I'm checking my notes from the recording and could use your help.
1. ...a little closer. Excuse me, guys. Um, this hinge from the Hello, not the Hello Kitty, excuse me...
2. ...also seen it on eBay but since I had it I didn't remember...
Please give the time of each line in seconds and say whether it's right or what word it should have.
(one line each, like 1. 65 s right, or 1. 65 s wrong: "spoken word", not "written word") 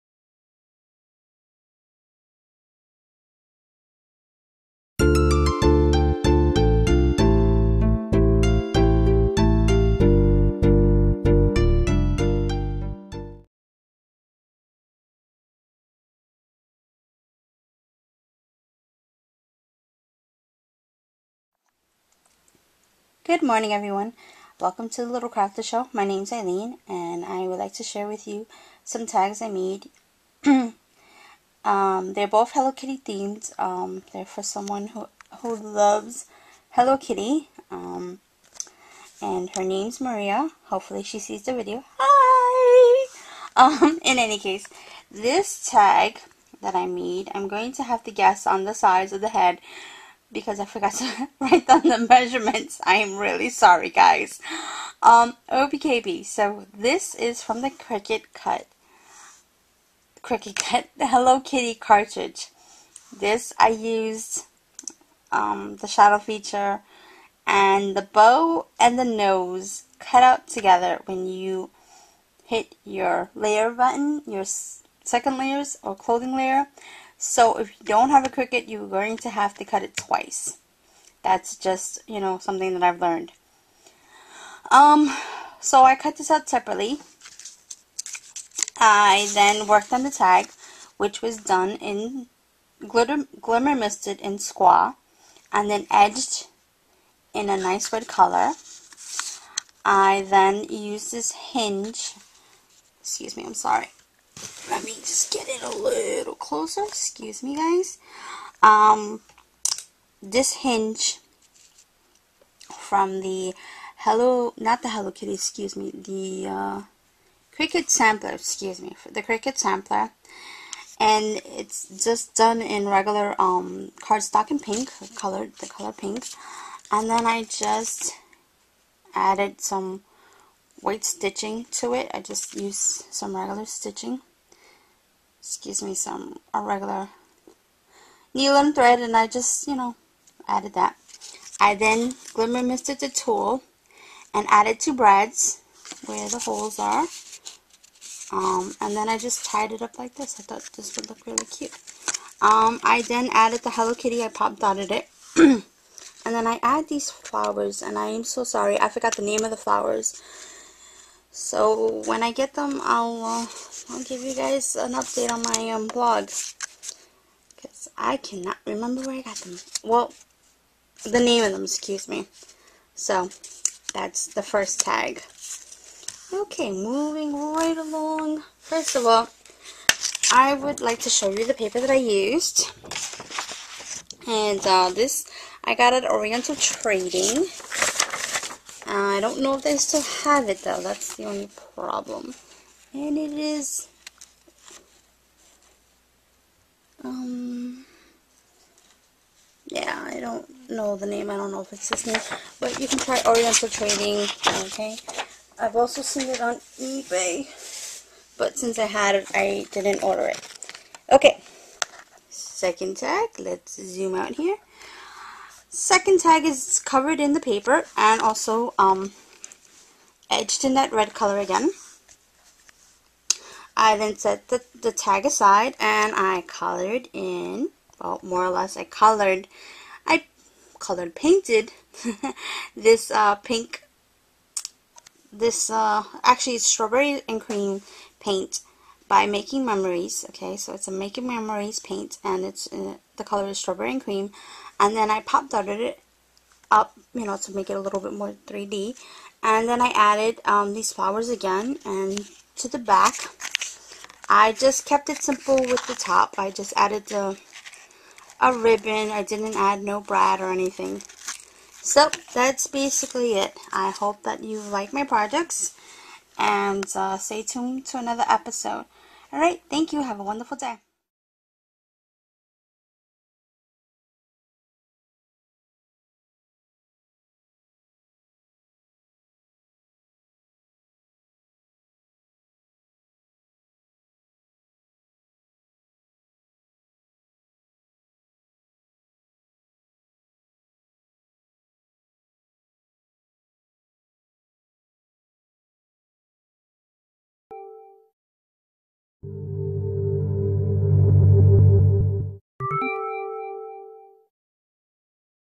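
1. 105 s right
2. 205 s wrong: "order", not "remember".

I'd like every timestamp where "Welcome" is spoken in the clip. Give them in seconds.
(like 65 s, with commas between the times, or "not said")
24 s.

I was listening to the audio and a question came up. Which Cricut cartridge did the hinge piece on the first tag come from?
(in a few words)
Cricut Sampler.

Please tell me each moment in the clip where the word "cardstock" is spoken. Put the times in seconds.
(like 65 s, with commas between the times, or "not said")
124 s.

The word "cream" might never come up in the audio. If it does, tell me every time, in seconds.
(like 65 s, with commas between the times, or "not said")
237 s, 244 s.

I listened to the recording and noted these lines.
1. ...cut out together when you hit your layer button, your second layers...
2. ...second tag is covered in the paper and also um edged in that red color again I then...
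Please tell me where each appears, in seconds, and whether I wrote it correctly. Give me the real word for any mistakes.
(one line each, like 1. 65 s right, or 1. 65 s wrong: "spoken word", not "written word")
1. 69 s right
2. 215 s right.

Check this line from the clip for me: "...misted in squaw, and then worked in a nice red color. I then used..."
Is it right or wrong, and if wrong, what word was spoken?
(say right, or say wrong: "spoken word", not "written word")
wrong: "edged", not "worked".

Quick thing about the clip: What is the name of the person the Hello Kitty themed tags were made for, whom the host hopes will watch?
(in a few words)
Maria.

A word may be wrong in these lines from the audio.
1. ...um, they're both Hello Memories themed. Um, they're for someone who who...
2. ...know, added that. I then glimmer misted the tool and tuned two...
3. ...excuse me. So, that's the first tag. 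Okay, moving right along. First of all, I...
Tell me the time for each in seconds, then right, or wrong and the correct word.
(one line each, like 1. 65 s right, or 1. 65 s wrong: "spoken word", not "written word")
1. 31 s wrong: "Kitty", not "Memories"
2. 139 s wrong: "added", not "tuned"
3. 171 s right.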